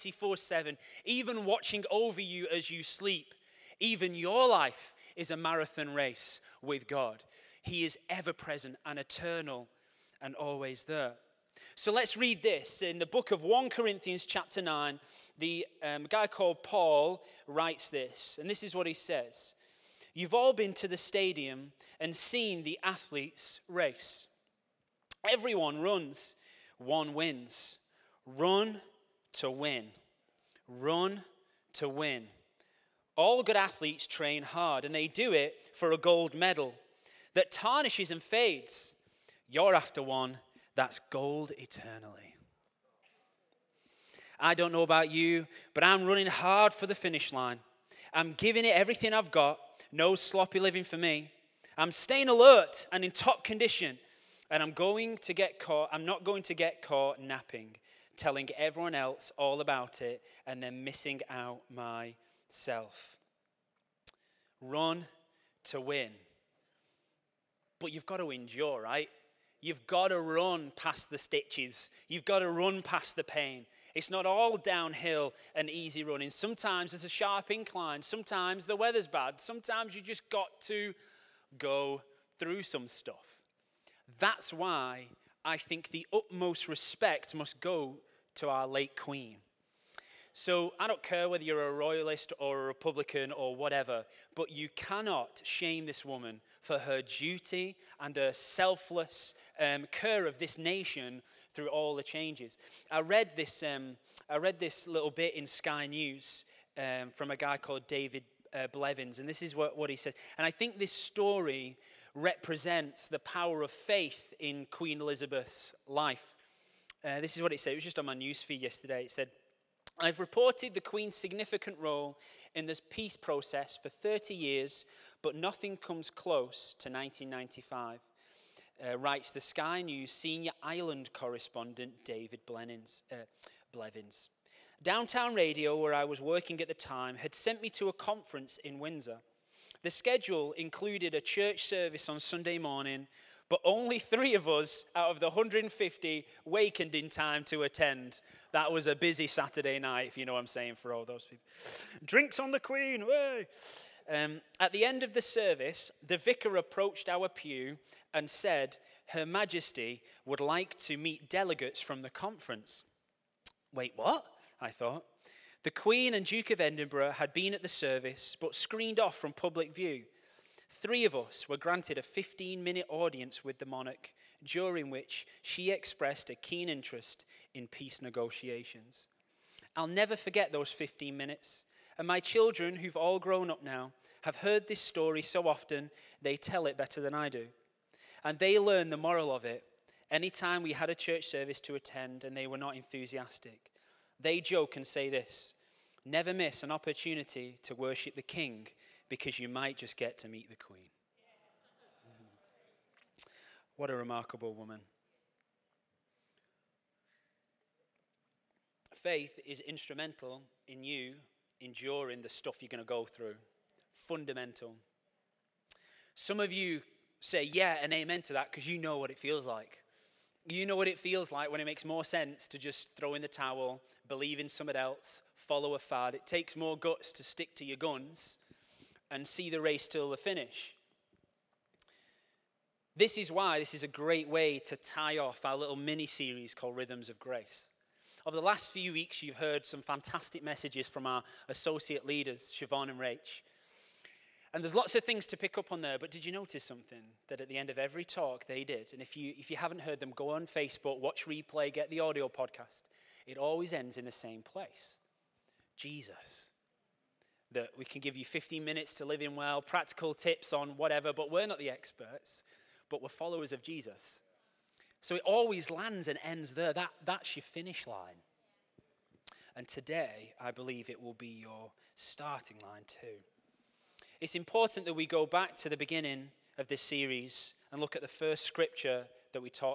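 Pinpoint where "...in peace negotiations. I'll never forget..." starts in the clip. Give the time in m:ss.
2:57.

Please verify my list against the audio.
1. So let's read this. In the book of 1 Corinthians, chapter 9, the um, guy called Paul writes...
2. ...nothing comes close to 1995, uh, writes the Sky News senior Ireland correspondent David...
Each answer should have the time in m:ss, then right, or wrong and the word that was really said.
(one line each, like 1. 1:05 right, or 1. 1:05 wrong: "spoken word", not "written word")
1. 0:11 right
2. 2:05 right.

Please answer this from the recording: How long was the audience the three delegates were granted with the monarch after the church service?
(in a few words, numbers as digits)
15 minutes.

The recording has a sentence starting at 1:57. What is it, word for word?
It was just on my newsfeed yesterday.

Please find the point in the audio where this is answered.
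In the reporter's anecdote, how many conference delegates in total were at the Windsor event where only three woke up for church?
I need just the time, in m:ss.
2:25.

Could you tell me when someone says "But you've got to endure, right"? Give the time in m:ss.
1:07.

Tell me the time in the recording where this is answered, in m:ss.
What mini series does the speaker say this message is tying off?
3:56.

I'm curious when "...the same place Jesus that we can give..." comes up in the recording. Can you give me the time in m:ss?
4:14.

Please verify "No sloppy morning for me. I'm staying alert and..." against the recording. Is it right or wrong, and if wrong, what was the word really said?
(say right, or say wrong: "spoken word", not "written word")
wrong: "living", not "morning".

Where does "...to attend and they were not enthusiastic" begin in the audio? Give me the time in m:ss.
3:11.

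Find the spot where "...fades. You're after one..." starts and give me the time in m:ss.
0:38.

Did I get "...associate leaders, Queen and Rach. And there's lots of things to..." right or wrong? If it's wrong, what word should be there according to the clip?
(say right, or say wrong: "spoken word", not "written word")
wrong: "Siobhan", not "Queen".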